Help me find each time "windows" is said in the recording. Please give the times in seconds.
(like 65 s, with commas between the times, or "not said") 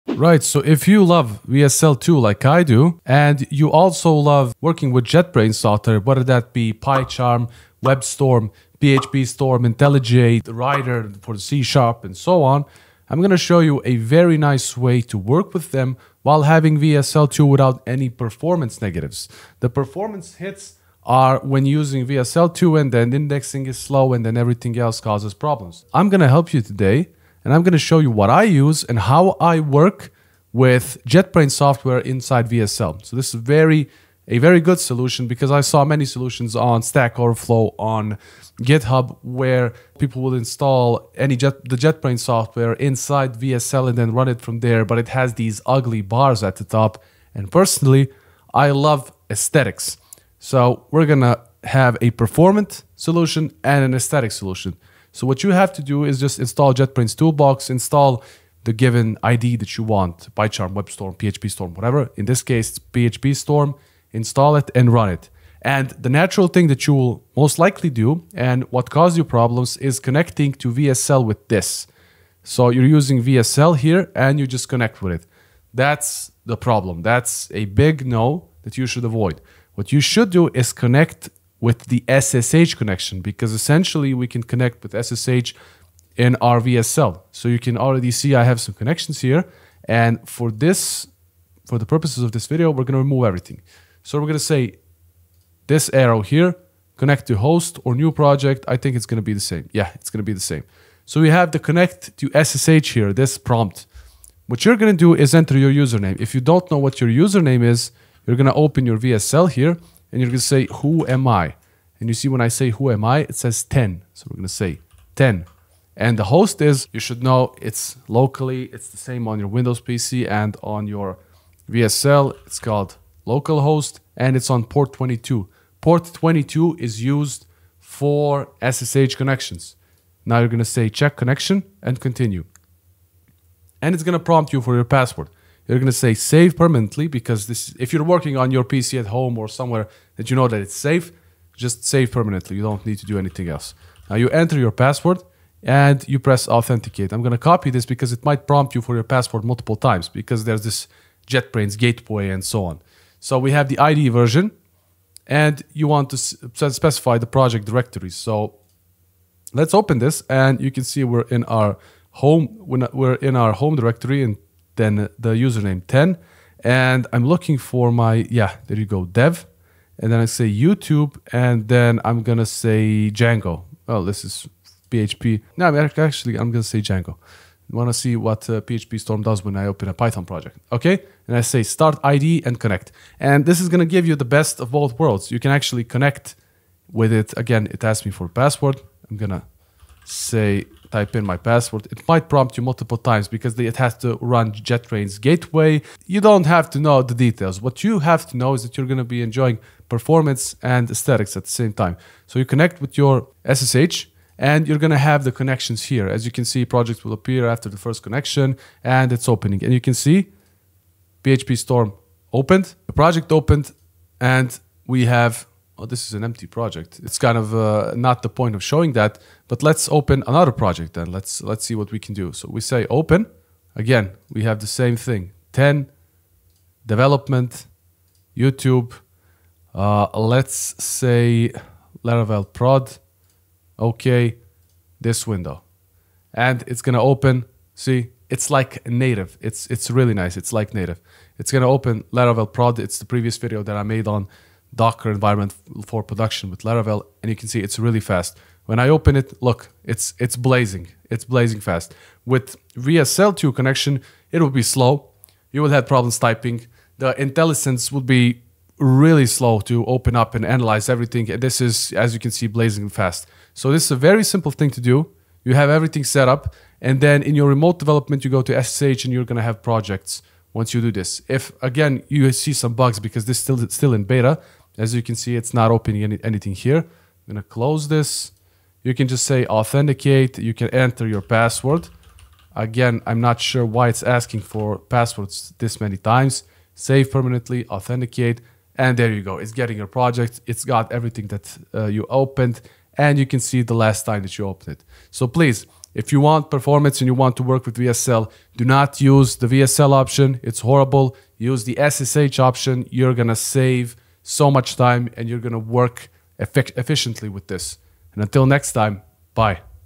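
119 s, 235 s.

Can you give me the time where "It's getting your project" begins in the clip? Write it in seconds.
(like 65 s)
289 s.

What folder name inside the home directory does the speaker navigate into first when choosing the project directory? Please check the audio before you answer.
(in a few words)
dev.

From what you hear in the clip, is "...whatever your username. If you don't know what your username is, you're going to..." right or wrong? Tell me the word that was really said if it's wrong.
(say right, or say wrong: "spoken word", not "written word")
wrong: "enter", not "whatever".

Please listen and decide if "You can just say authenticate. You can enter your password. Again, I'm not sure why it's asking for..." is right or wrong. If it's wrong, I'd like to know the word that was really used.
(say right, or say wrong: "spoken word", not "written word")
right.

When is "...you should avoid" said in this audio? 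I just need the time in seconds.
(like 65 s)
78 s.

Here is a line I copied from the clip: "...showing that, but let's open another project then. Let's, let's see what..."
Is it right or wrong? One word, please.
right.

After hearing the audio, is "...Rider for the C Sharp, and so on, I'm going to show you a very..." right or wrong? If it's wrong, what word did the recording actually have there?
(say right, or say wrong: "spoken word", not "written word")
right.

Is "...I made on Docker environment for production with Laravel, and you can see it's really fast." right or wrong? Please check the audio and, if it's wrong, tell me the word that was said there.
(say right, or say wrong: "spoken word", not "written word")
right.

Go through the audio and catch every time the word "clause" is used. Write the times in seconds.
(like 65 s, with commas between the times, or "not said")
not said.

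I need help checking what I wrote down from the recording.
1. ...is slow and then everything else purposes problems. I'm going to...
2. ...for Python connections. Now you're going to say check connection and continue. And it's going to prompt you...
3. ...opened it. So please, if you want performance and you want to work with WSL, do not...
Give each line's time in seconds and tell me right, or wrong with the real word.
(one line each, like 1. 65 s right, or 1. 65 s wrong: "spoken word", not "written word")
1. 23 s wrong: "causes", not "purposes"
2. 127 s wrong: "SSH", not "Python"
3. 294 s right.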